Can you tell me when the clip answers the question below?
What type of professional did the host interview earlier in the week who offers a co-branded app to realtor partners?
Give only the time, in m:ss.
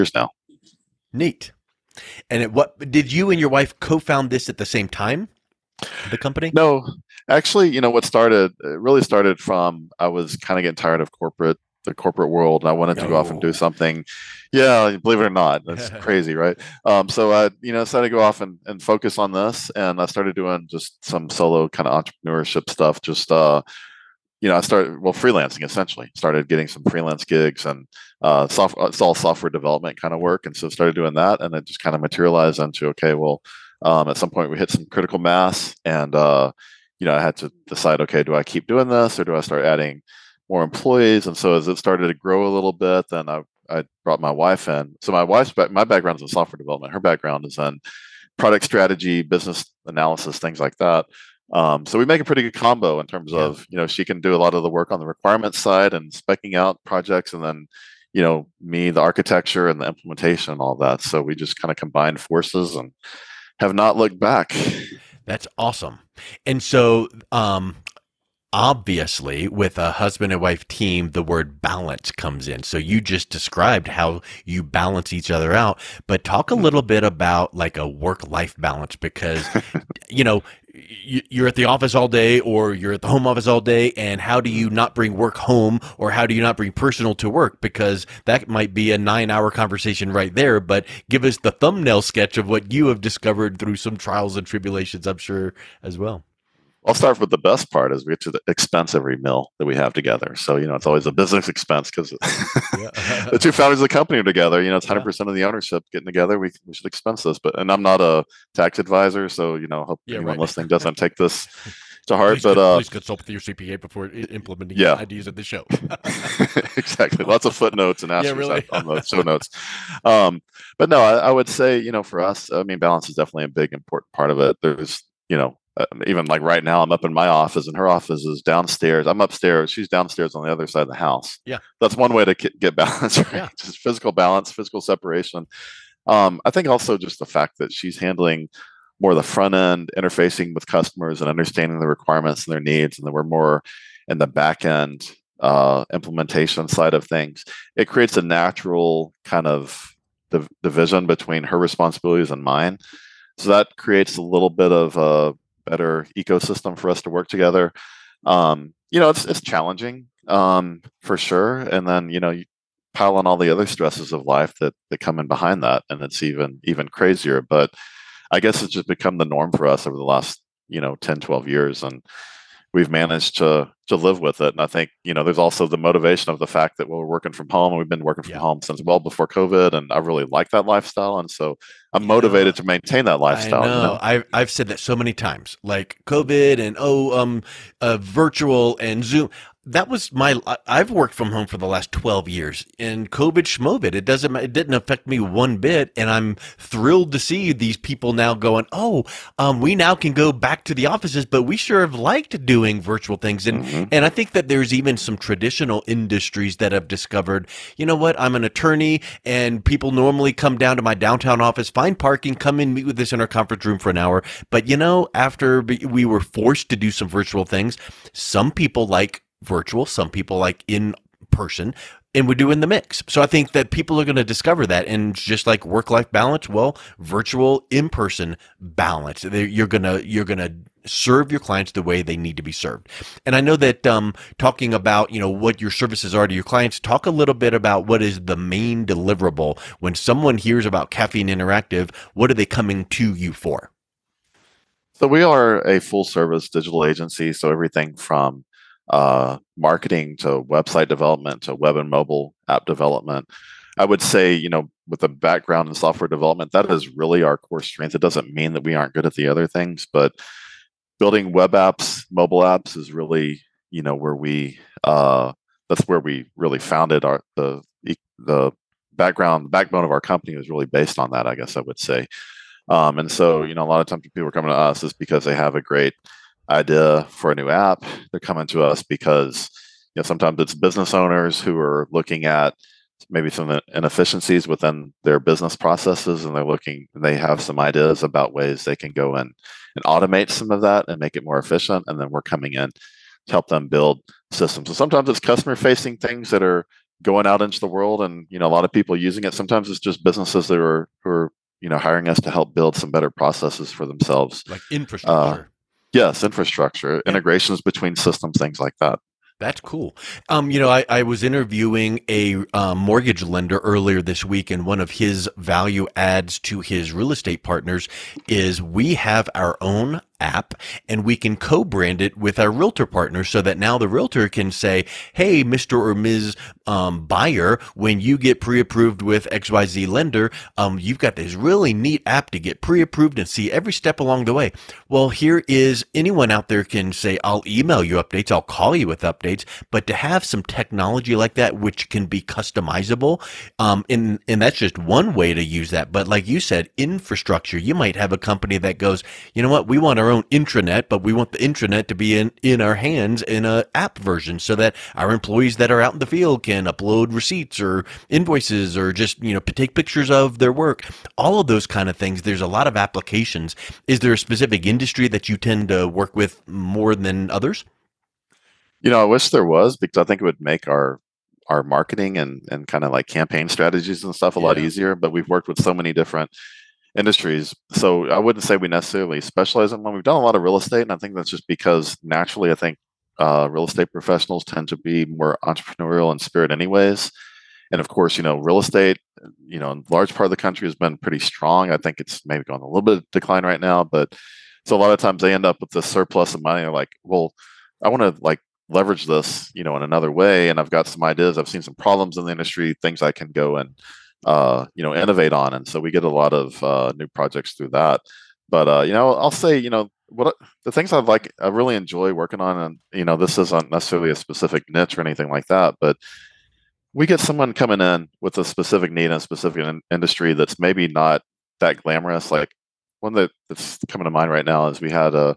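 5:12.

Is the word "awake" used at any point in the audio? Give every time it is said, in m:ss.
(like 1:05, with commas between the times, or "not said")
not said.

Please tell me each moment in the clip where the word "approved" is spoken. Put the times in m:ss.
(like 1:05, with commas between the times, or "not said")
5:28, 5:32.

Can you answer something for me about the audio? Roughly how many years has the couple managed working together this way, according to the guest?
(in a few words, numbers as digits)
10, 12 years.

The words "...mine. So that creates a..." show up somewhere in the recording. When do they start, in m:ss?
2:32.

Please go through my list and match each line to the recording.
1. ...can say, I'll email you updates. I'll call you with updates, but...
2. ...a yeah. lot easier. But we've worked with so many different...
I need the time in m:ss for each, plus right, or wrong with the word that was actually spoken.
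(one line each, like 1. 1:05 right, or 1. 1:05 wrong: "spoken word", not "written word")
1. 5:36 right
2. 6:14 right.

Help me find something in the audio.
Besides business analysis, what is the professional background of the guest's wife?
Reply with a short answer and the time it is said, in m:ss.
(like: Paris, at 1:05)
Product strategy, at 0:48.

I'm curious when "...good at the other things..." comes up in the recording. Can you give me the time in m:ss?
4:18.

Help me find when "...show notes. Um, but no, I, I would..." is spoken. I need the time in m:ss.
1:59.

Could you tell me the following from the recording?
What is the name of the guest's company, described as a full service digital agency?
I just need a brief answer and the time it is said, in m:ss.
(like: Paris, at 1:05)
Caffeine Interactive, at 4:00.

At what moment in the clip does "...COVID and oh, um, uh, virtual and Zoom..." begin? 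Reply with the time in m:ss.
3:06.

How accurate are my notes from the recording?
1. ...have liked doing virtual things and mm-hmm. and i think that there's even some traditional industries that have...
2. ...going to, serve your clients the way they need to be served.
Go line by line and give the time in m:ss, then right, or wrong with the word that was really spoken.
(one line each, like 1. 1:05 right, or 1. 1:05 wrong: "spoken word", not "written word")
1. 3:21 right
2. 3:50 right.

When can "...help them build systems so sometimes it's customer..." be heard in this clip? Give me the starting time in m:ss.
4:53.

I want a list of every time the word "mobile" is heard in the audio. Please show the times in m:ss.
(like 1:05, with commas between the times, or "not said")
4:11, 4:22.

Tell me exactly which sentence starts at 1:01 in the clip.
So we just kind of combined forces and have not looked back.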